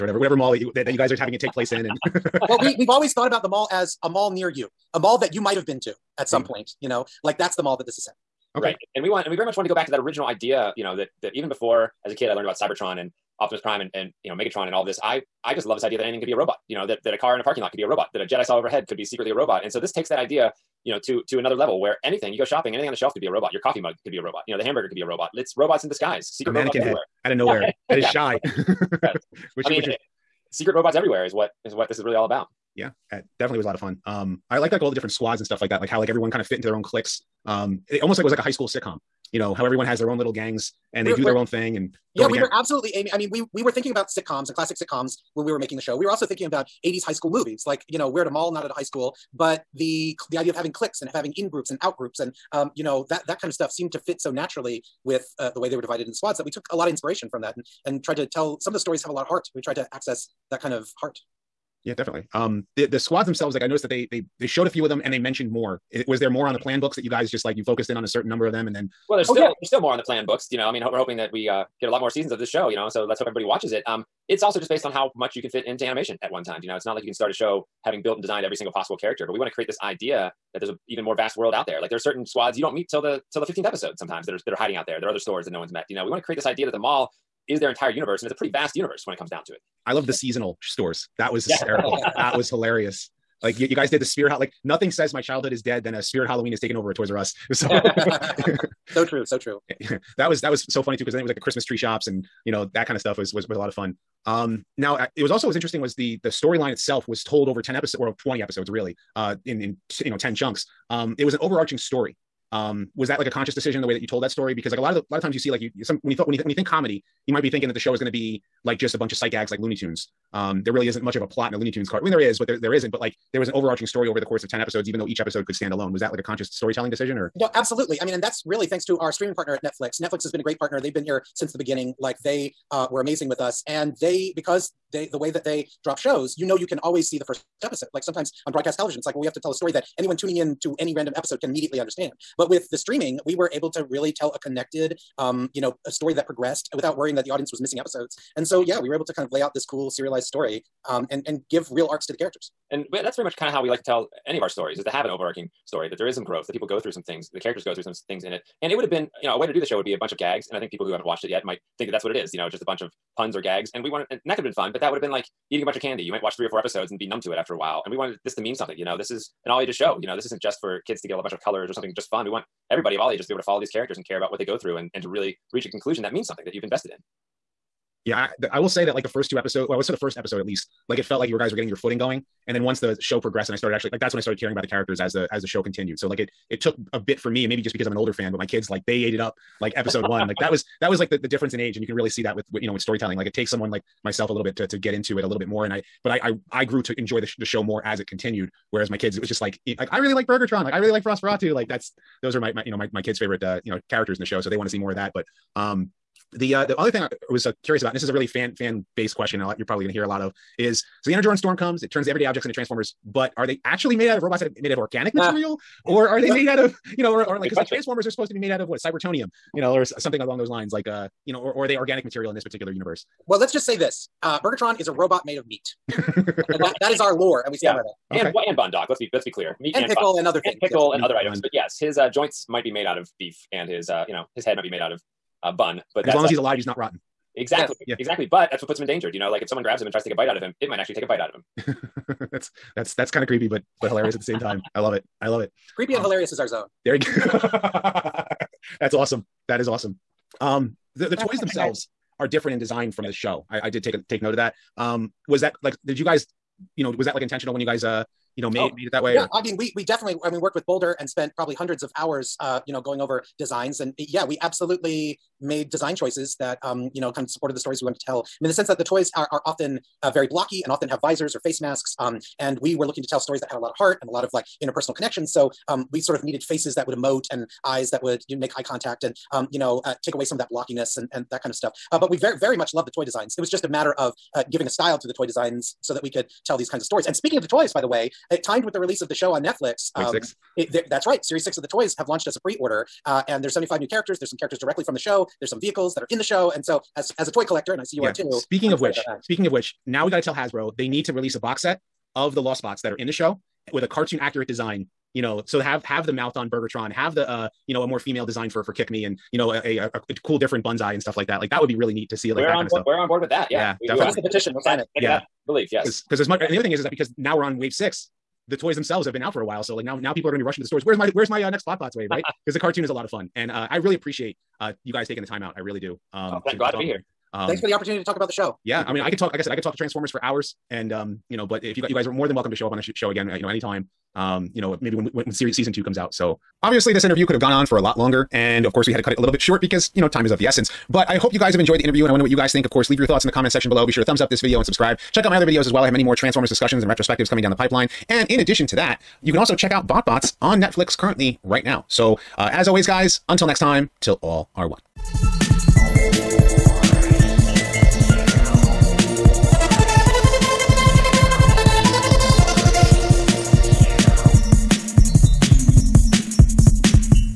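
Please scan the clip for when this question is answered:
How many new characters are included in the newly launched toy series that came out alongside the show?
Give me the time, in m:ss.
4:53.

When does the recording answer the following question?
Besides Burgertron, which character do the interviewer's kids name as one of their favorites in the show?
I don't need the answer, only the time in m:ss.
3:21.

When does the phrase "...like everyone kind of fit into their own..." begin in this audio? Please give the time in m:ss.
0:35.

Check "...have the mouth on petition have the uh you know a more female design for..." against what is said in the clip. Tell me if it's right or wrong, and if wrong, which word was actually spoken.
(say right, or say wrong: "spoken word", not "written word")
wrong: "burgertron", not "petition".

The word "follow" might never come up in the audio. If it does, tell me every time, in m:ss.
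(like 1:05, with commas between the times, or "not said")
2:53.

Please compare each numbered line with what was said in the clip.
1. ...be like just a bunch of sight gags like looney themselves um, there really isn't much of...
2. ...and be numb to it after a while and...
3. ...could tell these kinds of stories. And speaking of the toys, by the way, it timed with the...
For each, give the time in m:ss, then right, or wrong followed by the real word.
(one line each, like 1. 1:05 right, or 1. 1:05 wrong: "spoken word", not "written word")
1. 1:58 wrong: "tunes", not "themselves"
2. 2:46 right
3. 4:46 right.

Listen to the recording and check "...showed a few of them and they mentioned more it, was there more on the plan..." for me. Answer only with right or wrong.
right.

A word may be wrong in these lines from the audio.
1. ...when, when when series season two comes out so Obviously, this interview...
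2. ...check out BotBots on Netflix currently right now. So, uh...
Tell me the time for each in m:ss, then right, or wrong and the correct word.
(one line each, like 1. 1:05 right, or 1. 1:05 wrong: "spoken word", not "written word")
1. 5:34 right
2. 5:49 right.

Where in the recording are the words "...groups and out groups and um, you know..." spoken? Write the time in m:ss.
0:51.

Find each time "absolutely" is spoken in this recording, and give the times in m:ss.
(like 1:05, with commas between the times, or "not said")
0:42, 2:07, 4:24.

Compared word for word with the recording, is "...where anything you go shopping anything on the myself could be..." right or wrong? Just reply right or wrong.
wrong.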